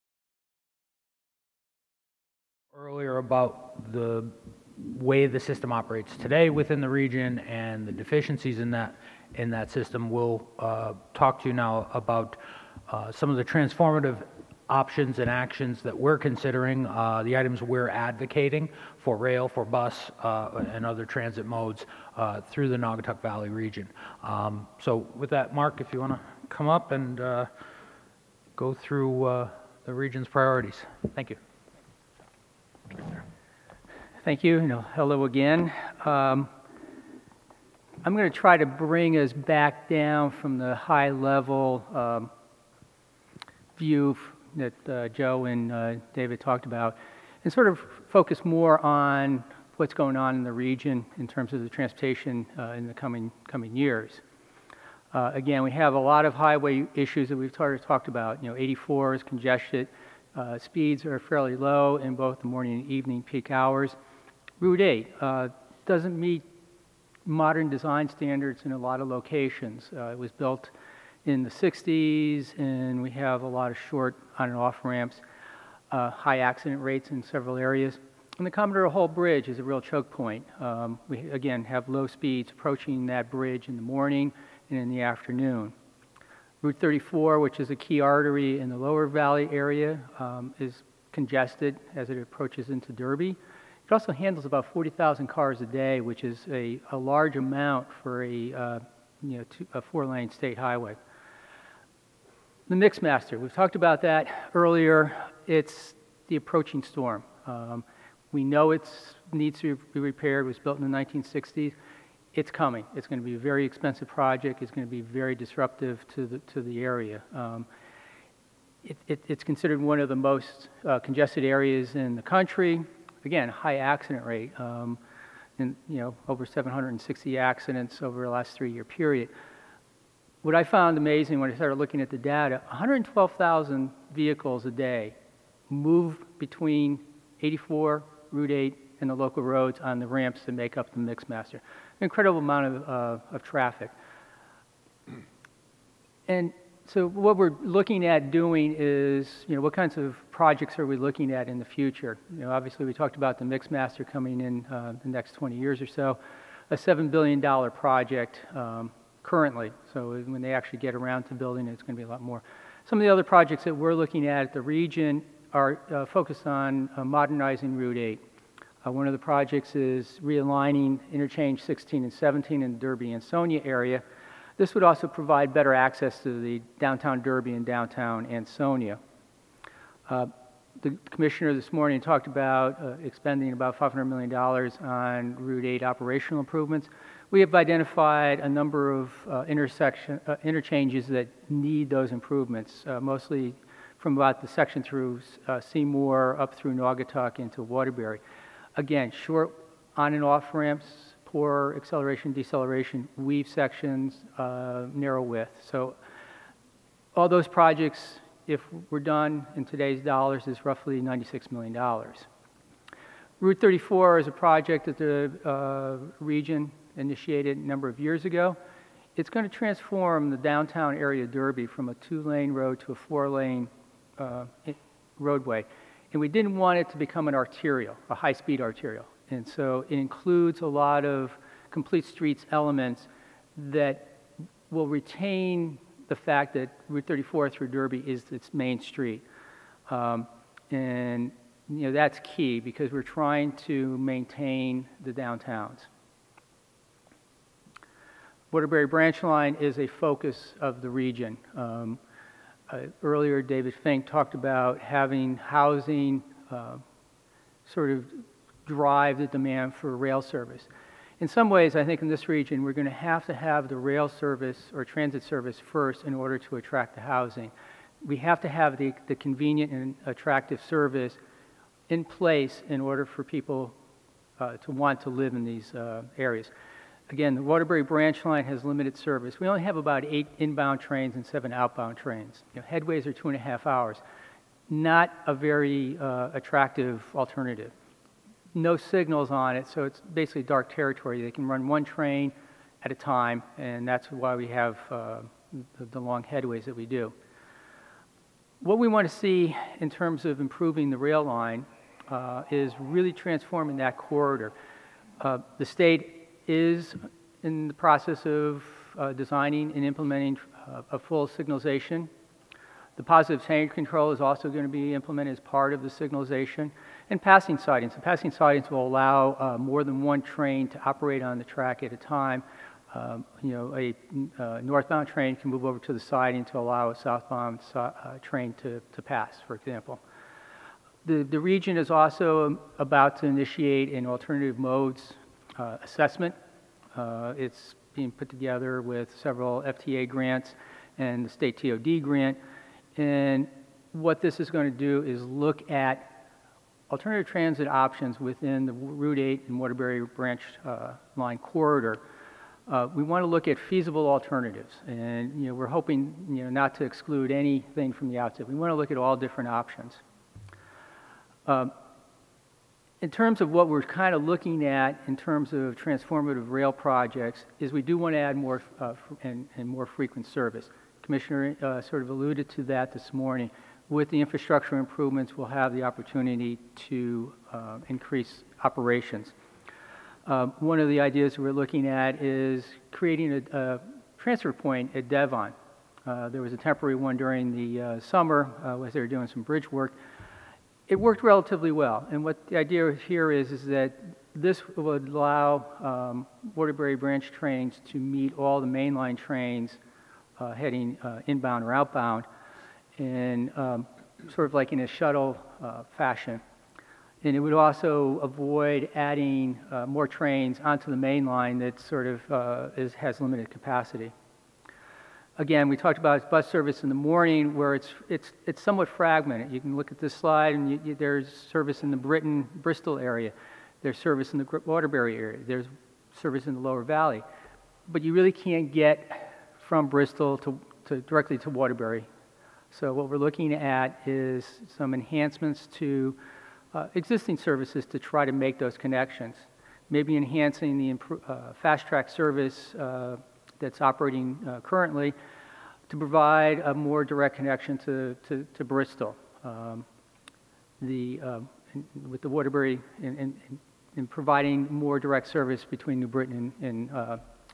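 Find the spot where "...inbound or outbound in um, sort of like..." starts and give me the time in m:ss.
6:41.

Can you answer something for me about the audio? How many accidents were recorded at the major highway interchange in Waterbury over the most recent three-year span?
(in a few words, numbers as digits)
over 760.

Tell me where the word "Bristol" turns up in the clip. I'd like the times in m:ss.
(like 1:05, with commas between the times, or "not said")
7:02, 7:09, 7:28.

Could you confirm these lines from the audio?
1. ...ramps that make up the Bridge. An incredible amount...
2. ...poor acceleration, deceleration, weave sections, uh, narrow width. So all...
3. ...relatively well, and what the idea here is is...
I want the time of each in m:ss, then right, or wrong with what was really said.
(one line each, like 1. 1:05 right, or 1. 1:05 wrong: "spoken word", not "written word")
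1. 2:20 wrong: "Mixmaster", not "Bridge"
2. 3:21 right
3. 6:31 right.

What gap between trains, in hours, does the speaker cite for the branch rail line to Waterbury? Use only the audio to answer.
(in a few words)
2.5 hours.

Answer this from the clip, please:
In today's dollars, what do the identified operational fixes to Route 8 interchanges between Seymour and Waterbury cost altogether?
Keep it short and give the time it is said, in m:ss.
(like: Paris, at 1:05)
$96 million, at 3:31.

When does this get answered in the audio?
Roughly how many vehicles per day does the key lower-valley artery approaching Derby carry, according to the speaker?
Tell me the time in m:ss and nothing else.
1:34.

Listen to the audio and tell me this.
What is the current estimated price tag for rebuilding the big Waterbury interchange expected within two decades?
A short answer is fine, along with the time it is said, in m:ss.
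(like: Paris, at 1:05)
$7 billion, at 2:36.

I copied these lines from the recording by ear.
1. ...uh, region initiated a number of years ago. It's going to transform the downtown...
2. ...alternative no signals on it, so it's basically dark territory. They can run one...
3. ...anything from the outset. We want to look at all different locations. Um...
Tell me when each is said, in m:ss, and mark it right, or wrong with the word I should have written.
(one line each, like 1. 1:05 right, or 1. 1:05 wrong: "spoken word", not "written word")
1. 3:35 right
2. 4:47 right
3. 5:57 wrong: "options", not "locations".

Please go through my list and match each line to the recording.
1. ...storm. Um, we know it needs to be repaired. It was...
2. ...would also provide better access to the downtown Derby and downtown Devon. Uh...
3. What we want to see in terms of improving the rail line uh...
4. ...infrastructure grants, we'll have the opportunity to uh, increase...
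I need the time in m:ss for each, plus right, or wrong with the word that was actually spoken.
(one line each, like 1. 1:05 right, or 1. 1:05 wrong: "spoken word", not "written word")
1. 1:46 right
2. 2:54 wrong: "Ansonia", not "Devon"
3. 4:58 right
4. 6:14 wrong: "improvements", not "grants".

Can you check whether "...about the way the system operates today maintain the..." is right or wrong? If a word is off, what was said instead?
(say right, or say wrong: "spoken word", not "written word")
wrong: "within", not "maintain".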